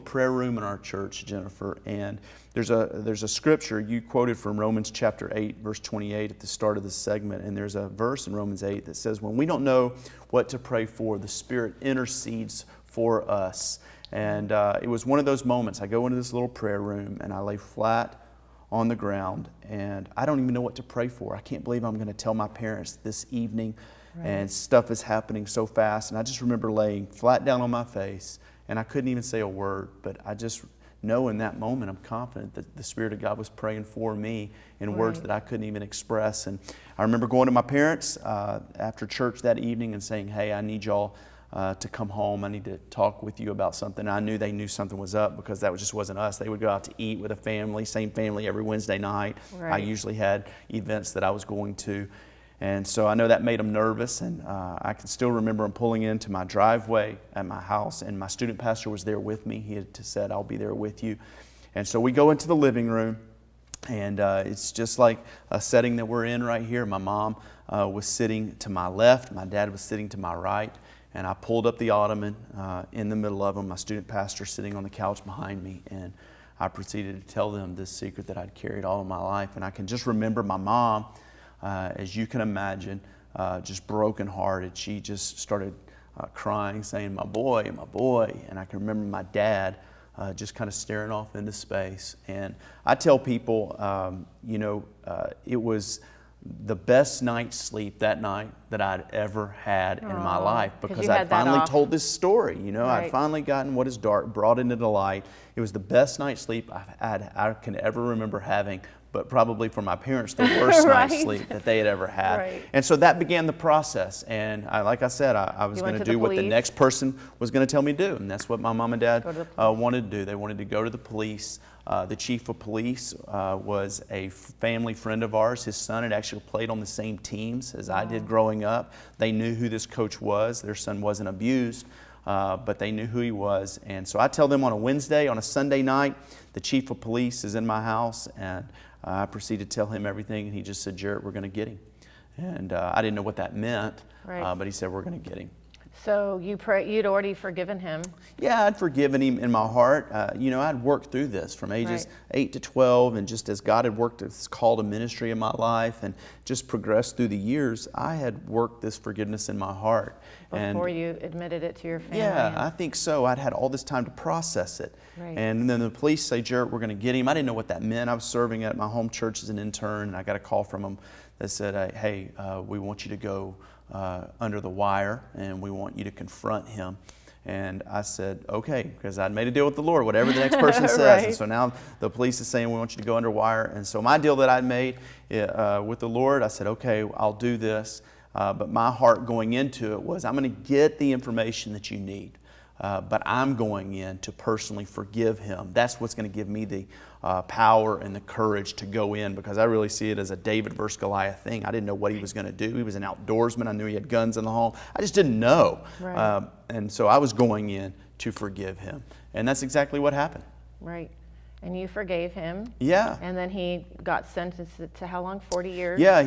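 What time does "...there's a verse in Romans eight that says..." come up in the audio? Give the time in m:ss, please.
0:07.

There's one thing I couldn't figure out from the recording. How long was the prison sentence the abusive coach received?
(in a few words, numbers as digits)
40 years.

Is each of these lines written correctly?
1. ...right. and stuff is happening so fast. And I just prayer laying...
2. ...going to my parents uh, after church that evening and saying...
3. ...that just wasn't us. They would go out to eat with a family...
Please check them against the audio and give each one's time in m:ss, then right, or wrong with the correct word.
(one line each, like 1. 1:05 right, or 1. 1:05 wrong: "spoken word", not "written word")
1. 0:24 wrong: "remember", not "prayer"
2. 0:37 right
3. 0:45 right.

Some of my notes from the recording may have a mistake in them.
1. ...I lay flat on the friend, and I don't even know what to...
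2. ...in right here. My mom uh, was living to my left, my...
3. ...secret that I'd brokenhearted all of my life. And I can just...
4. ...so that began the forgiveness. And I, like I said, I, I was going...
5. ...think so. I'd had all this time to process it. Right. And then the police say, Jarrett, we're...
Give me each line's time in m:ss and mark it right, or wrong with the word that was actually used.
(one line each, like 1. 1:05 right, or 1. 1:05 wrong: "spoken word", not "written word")
1. 0:17 wrong: "ground", not "friend"
2. 1:06 wrong: "sitting", not "living"
3. 1:17 wrong: "carried", not "brokenhearted"
4. 1:52 wrong: "process", not "forgiveness"
5. 2:42 right.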